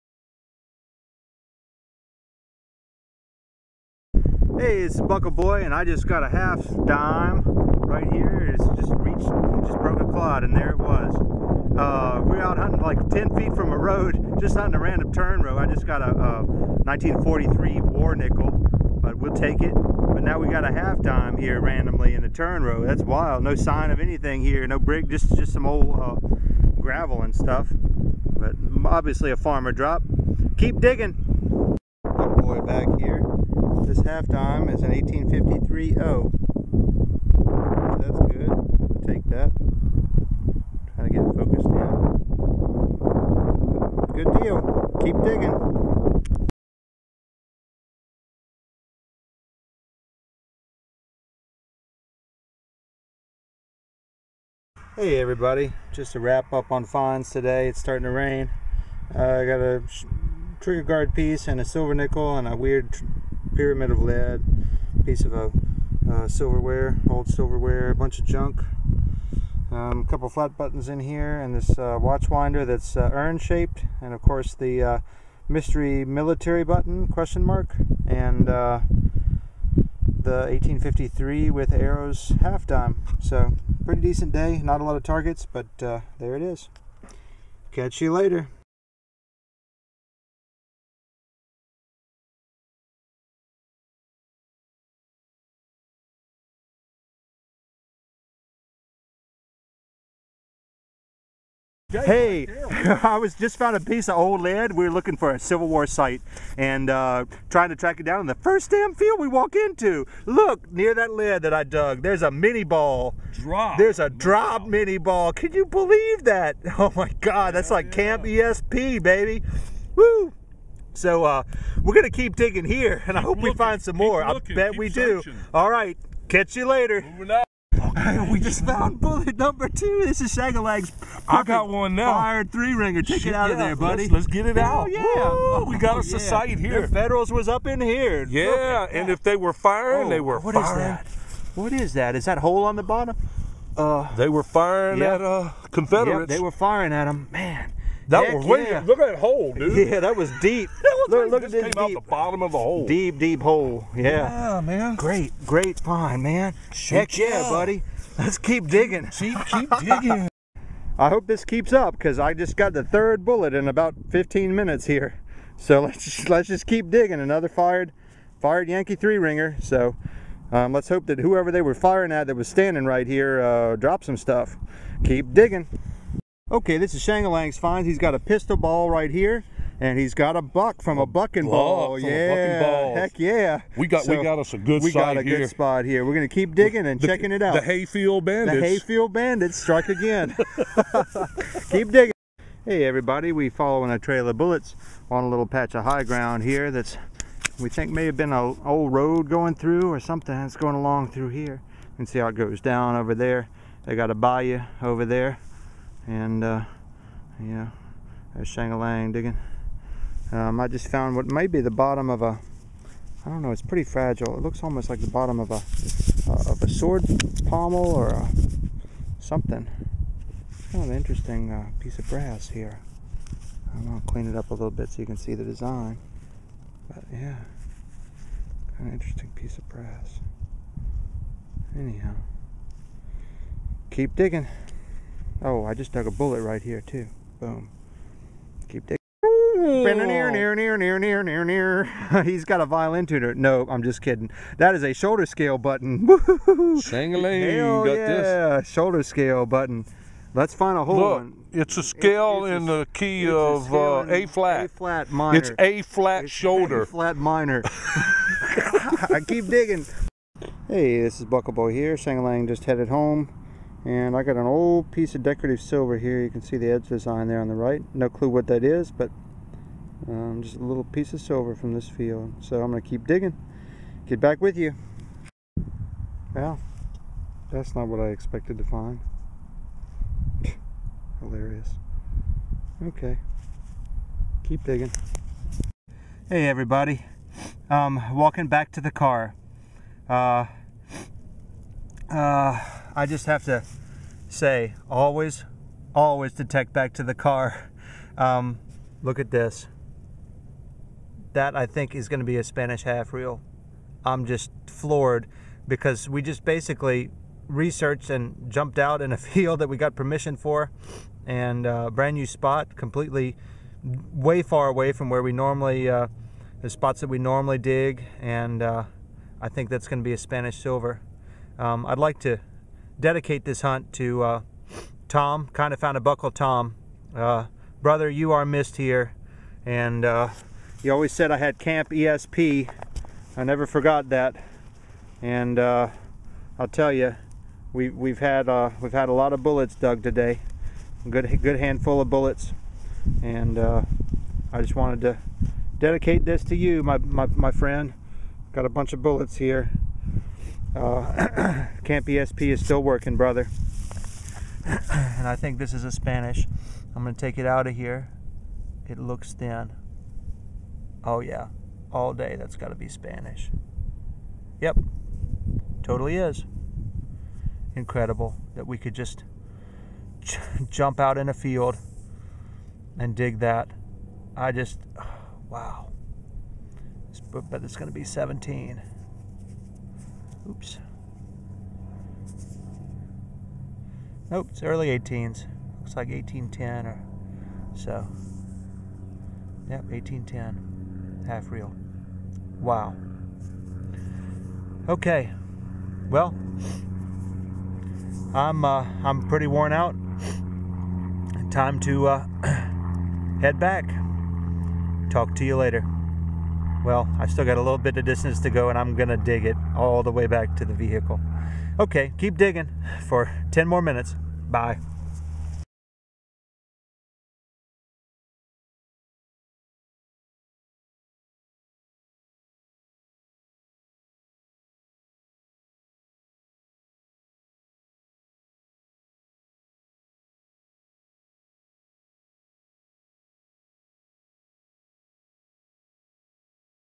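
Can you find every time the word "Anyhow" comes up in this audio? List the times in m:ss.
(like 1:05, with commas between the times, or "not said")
3:51.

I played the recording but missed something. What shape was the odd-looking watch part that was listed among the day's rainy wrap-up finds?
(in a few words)
Urn shaped.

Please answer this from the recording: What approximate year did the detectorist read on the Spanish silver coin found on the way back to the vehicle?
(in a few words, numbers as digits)
1810.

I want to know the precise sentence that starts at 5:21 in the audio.
Um, I'd like to dedicate this hunt to uh, Tom, kind of found a buckle Tom.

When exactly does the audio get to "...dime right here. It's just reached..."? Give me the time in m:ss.
0:06.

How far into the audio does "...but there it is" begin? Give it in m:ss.
1:25.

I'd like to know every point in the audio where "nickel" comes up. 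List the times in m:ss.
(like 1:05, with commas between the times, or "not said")
0:18, 1:01.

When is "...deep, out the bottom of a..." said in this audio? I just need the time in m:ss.
2:31.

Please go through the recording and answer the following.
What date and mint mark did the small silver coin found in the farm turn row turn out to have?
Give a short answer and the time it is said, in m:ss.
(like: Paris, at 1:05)
1853 O, at 0:34.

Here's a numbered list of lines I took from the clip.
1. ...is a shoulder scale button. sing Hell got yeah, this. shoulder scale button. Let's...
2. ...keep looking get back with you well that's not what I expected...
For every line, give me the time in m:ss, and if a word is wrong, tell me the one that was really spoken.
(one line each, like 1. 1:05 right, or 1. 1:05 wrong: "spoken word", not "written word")
1. 4:04 right
2. 4:32 wrong: "digging", not "looking".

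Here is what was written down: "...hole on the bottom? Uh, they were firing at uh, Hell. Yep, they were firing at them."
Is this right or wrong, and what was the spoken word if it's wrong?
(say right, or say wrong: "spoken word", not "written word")
wrong: "Confederates", not "Hell".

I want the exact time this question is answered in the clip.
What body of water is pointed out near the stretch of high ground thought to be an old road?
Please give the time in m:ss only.
3:24.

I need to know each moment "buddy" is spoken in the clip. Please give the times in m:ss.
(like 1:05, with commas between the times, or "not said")
2:13, 2:37.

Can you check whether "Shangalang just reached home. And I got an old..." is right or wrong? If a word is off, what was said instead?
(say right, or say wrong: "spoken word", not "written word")
wrong: "headed", not "reached".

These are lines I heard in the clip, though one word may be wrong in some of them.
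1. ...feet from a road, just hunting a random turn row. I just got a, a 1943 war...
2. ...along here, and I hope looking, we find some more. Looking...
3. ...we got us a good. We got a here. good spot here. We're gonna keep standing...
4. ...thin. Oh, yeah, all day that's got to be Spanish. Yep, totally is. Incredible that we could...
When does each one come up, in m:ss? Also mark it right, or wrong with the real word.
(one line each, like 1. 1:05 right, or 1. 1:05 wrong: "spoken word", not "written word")
1. 0:13 right
2. 2:02 wrong: "digging", not "along"
3. 3:04 wrong: "digging", not "standing"
4. 5:59 right.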